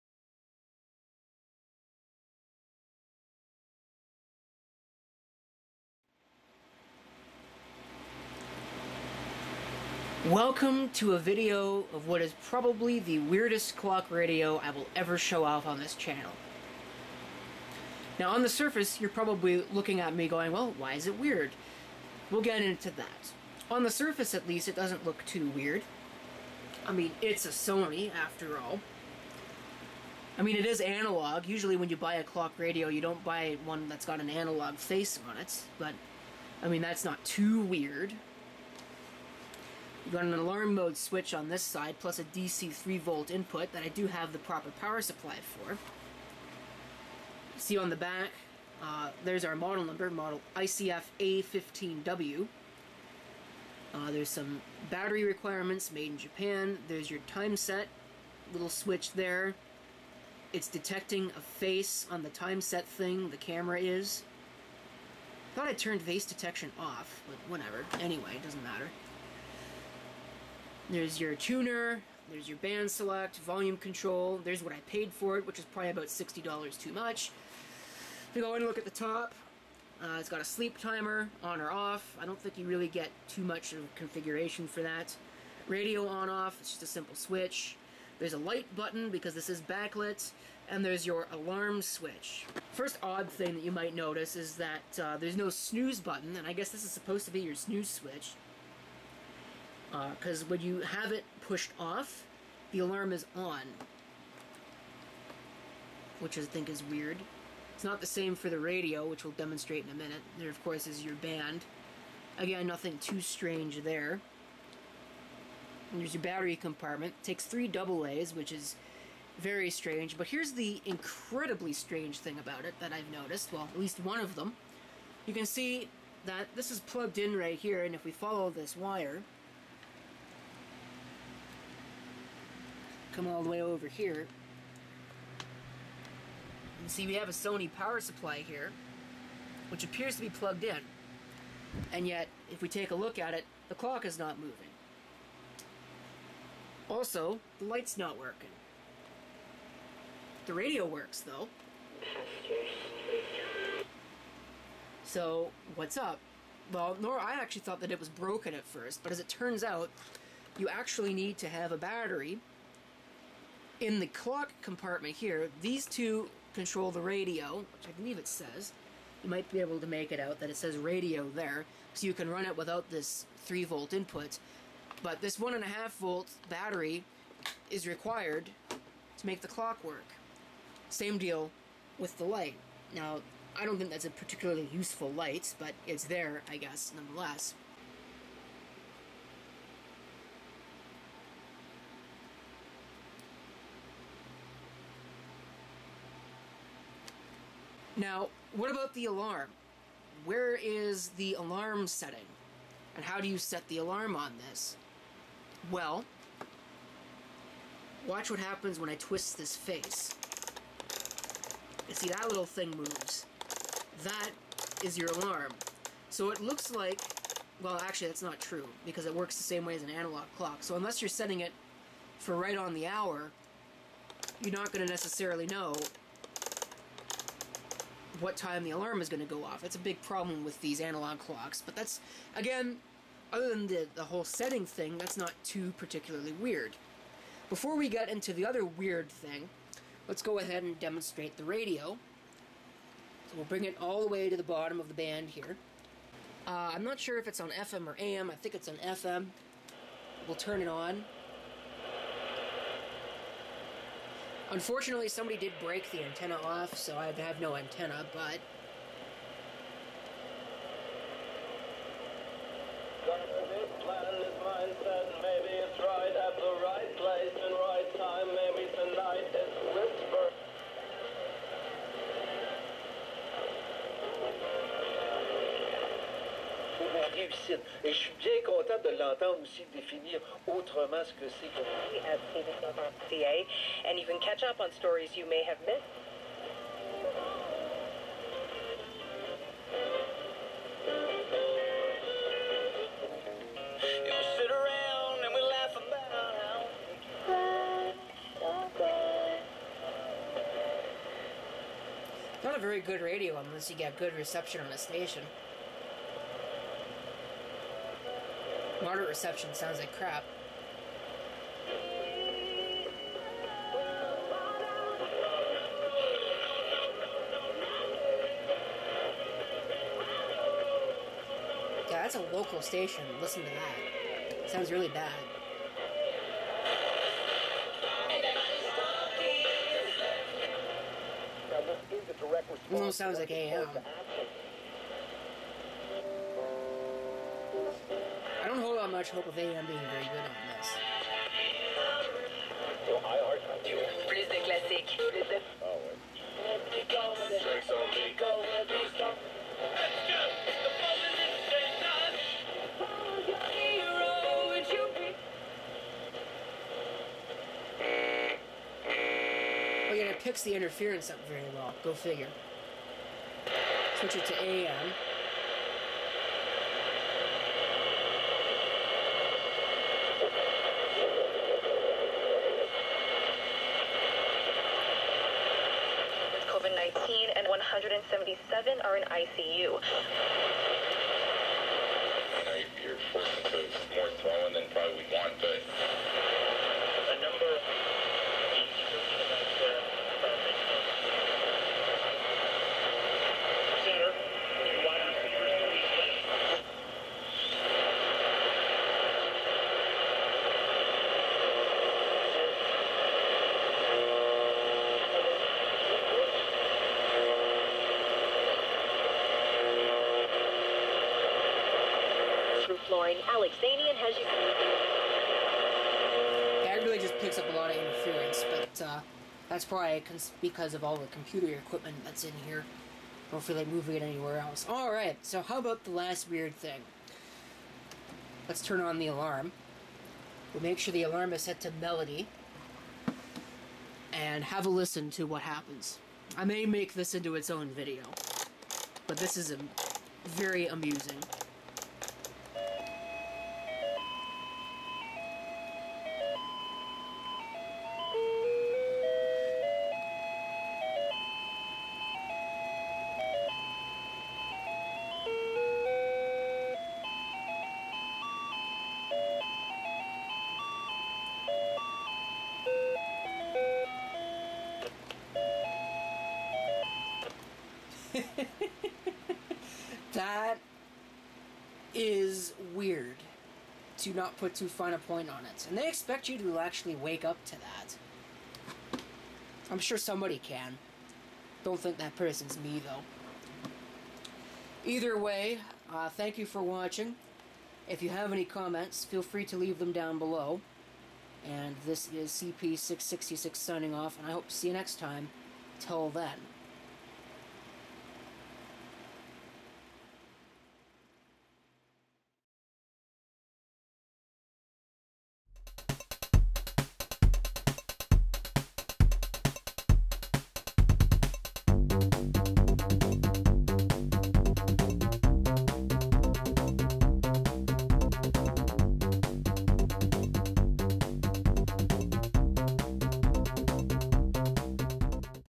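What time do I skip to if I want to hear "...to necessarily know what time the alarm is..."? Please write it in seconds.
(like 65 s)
224 s.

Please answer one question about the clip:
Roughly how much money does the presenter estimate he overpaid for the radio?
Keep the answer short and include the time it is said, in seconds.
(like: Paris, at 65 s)
$60, at 76 s.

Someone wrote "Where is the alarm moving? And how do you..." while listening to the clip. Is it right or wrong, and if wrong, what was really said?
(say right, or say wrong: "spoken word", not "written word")
wrong: "setting", not "moving".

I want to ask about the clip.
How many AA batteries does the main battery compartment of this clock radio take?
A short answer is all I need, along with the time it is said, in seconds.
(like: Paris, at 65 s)
3, at 117 s.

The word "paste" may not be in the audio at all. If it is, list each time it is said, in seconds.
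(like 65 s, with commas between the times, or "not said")
not said.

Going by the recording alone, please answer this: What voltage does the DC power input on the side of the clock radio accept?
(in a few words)
3 volt.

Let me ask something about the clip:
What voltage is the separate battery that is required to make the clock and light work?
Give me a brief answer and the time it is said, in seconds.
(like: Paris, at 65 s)
1.5 volt, at 175 s.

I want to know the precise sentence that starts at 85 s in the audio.
Radio on off, it's just a simple switch.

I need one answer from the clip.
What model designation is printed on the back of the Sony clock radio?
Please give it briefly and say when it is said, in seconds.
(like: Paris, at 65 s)
ICF A15W, at 50 s.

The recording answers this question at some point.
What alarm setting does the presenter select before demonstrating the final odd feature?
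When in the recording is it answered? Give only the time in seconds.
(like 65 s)
431 s.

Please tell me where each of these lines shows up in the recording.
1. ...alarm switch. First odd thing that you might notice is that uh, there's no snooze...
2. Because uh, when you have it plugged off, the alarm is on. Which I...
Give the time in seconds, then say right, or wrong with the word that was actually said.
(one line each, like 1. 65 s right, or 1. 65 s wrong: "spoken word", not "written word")
1. 91 s right
2. 99 s wrong: "pushed", not "plugged".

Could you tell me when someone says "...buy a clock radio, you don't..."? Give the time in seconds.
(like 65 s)
31 s.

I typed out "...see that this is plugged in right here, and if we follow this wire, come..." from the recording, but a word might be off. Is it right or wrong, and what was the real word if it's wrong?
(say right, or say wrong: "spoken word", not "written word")
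right.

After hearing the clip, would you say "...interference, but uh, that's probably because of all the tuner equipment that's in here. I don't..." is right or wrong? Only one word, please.
wrong.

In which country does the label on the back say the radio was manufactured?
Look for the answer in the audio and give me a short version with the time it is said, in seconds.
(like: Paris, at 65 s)
Japan, at 56 s.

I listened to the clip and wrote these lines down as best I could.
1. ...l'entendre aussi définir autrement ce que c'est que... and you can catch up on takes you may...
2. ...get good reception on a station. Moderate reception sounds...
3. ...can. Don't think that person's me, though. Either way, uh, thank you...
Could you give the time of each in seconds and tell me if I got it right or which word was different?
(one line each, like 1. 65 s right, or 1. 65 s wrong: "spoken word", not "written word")
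1. 278 s wrong: "stories", not "takes"
2. 303 s right
3. 480 s right.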